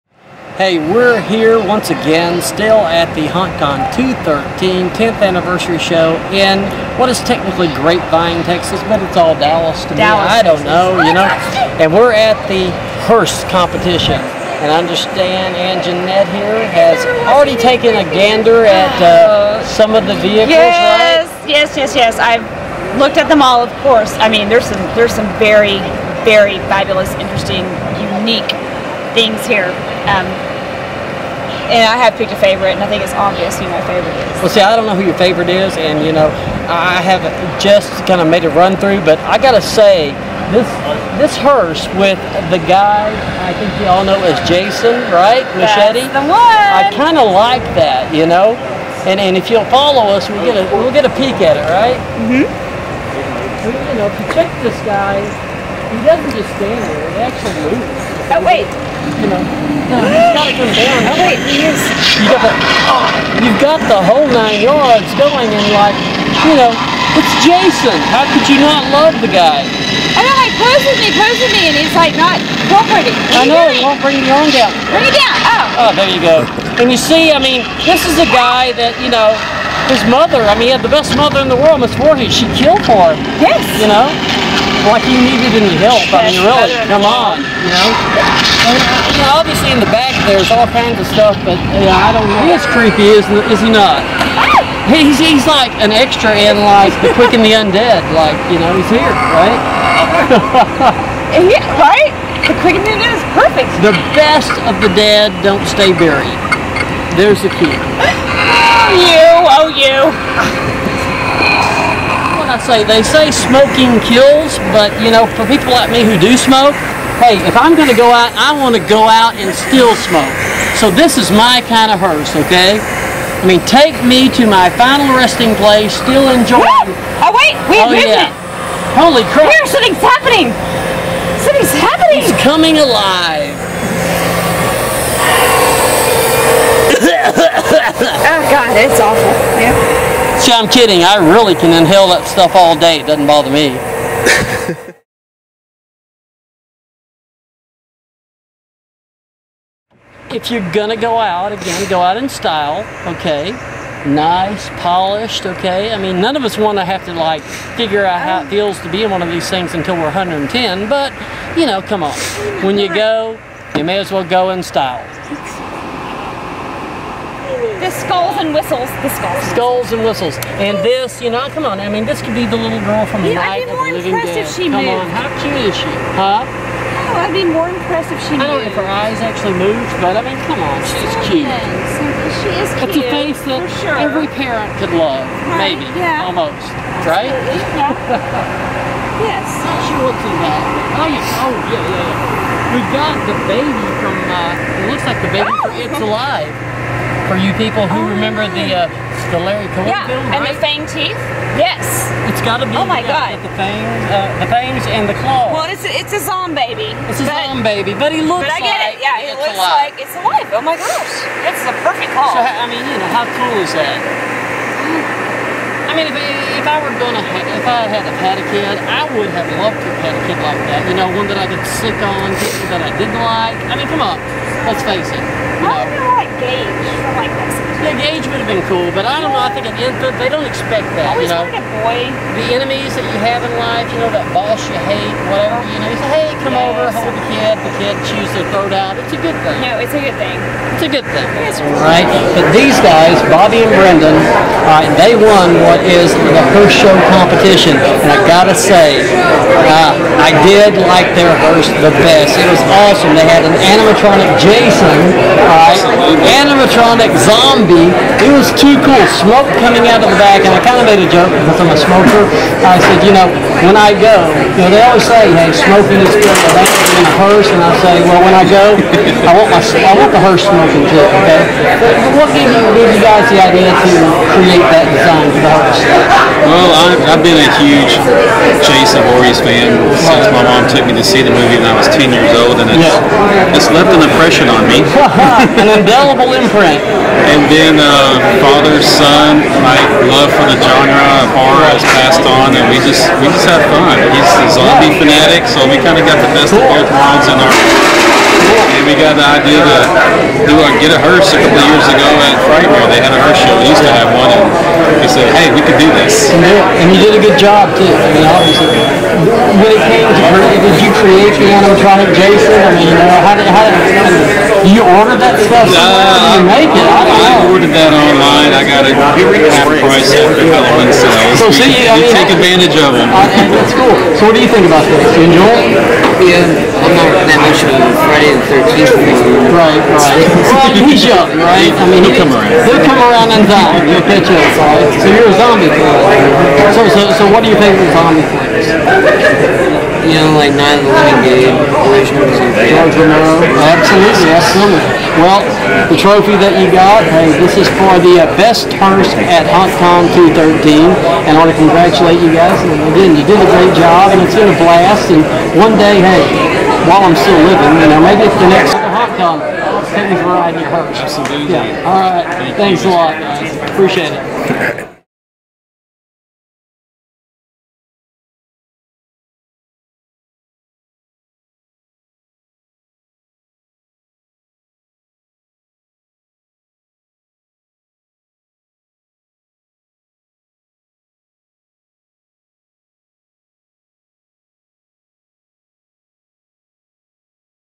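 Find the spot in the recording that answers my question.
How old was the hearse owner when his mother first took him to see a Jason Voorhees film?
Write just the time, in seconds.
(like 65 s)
281 s.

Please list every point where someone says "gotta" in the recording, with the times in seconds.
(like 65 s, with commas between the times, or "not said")
39 s, 60 s, 248 s.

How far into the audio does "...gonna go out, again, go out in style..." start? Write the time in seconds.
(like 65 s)
150 s.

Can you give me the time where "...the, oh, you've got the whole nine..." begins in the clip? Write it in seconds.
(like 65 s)
62 s.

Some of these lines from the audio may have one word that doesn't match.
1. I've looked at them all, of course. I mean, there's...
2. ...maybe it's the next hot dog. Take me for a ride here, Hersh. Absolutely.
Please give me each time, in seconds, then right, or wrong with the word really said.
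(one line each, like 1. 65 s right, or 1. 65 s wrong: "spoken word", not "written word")
1. 22 s right
2. 358 s right.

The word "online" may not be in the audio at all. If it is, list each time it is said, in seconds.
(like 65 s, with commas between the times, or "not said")
317 s.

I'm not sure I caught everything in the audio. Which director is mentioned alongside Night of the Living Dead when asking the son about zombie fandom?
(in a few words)
George Romero.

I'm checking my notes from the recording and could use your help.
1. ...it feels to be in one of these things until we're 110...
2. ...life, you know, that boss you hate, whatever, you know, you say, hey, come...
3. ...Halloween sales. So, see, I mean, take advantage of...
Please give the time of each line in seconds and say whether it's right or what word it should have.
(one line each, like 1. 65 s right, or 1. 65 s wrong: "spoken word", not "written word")
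1. 158 s right
2. 233 s right
3. 320 s right.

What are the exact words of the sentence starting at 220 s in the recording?
You know, one that I could sit on, that I didn't like.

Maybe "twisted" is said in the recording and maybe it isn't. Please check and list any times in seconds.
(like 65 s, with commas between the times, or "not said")
not said.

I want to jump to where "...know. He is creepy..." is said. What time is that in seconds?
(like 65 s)
92 s.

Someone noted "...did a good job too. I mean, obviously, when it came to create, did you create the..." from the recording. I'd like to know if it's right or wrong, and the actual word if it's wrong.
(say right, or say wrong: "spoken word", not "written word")
right.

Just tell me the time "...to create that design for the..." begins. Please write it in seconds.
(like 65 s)
273 s.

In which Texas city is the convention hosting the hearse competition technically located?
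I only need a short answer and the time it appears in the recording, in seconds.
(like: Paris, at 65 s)
Grapevine, at 7 s.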